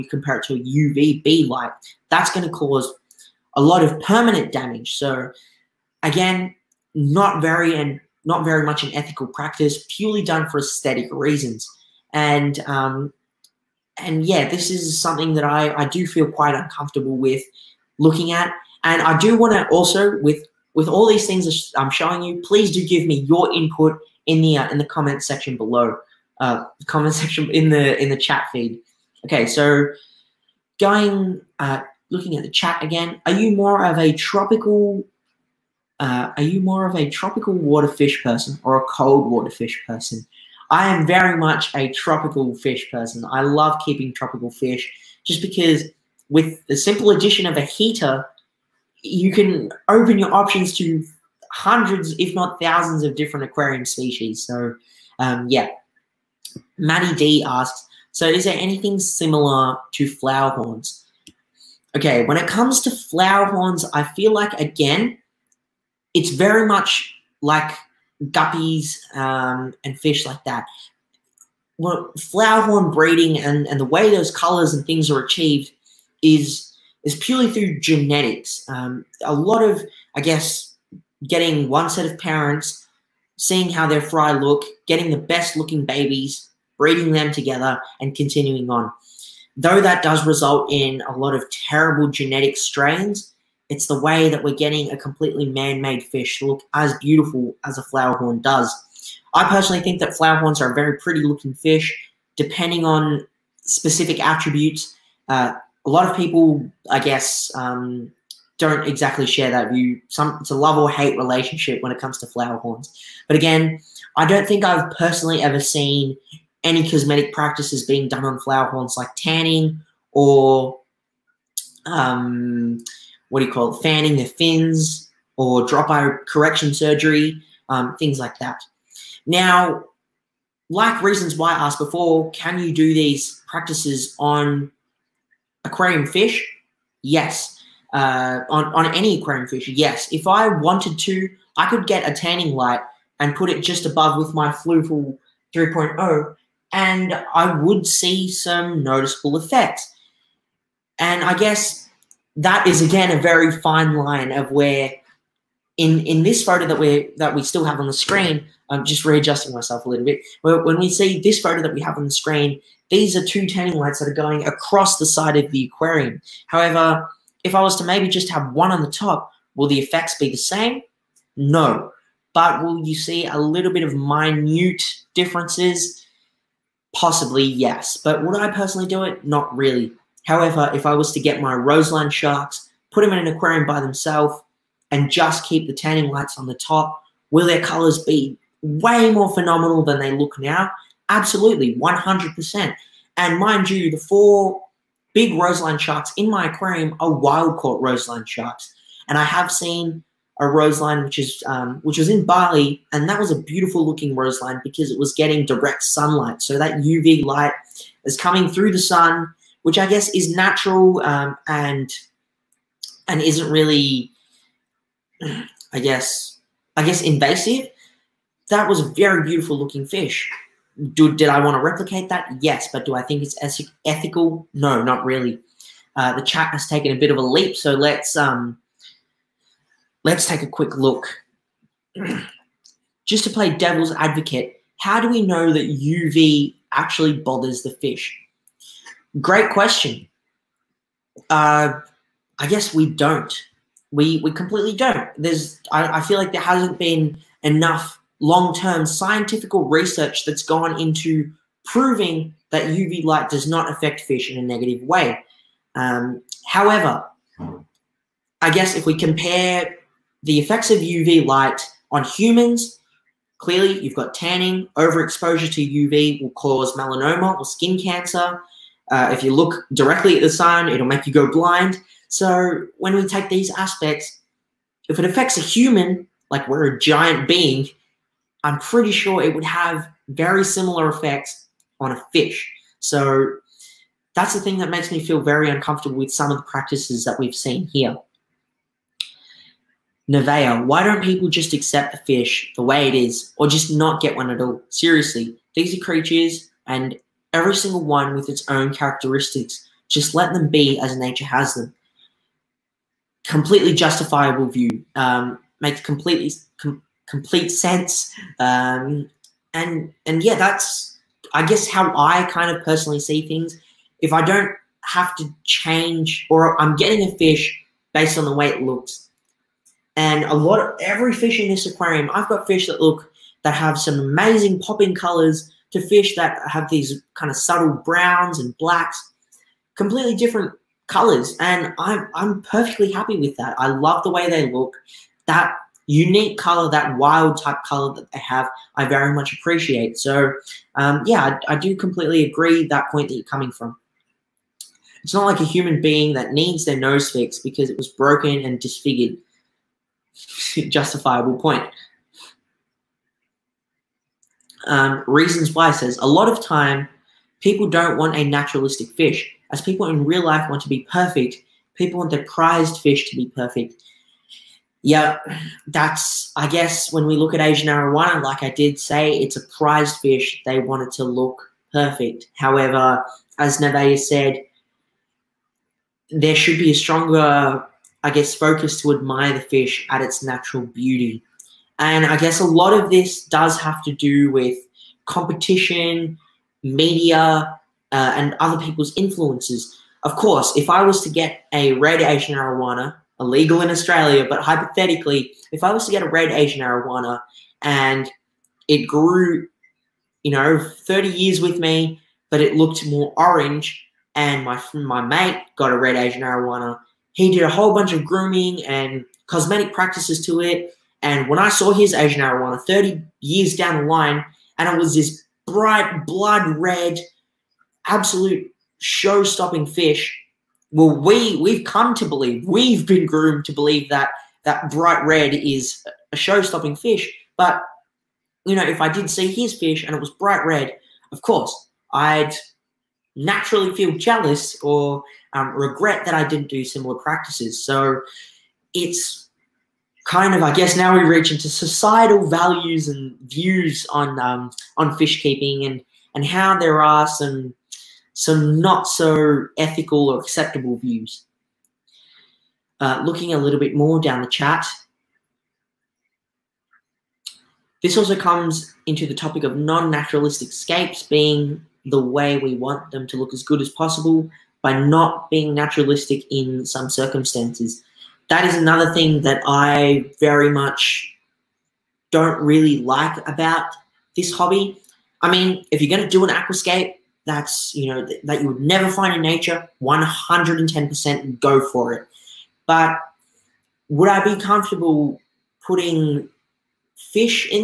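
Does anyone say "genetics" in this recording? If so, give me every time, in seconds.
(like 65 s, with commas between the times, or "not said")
77 s, 92 s.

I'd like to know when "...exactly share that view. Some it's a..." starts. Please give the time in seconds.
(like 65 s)
108 s.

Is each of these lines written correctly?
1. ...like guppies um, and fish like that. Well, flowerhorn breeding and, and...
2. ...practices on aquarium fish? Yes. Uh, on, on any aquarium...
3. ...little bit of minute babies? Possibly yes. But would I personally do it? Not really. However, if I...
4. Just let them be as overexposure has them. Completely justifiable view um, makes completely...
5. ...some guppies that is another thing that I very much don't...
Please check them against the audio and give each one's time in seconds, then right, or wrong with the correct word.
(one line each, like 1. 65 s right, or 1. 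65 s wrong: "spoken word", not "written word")
1. 67 s right
2. 133 s right
3. 173 s wrong: "differences", not "babies"
4. 299 s wrong: "nature", not "overexposure"
5. 466 s wrong: "circumstances", not "guppies".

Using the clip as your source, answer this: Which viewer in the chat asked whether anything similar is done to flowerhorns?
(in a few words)
Manny D.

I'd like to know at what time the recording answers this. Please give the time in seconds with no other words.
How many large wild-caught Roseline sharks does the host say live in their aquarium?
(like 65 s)
193 s.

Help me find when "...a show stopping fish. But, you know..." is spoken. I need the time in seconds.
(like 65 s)
426 s.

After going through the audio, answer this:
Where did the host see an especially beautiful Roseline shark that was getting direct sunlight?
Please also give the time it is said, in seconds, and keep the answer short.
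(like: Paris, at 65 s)
Bali, at 202 s.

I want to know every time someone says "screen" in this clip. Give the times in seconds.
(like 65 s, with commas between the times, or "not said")
157 s, 162 s.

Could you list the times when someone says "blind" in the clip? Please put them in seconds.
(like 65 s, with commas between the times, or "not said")
271 s.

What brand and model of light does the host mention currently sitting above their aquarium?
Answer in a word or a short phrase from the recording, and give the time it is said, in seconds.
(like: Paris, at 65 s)
Fluval 3.0, at 144 s.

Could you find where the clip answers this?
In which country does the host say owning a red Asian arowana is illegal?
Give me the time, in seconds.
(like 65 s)
393 s.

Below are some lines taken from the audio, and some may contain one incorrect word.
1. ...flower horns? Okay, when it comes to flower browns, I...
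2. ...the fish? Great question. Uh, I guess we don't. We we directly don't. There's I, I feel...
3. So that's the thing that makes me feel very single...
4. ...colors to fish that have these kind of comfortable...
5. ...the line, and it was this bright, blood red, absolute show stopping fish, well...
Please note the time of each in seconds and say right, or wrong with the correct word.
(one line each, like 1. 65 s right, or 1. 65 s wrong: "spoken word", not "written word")
1. 60 s wrong: "horns", not "browns"
2. 237 s wrong: "completely", not "directly"
3. 282 s wrong: "uncomfortable", not "single"
4. 324 s wrong: "subtle", not "comfortable"
5. 413 s right.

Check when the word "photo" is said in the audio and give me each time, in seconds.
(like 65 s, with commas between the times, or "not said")
156 s, 161 s.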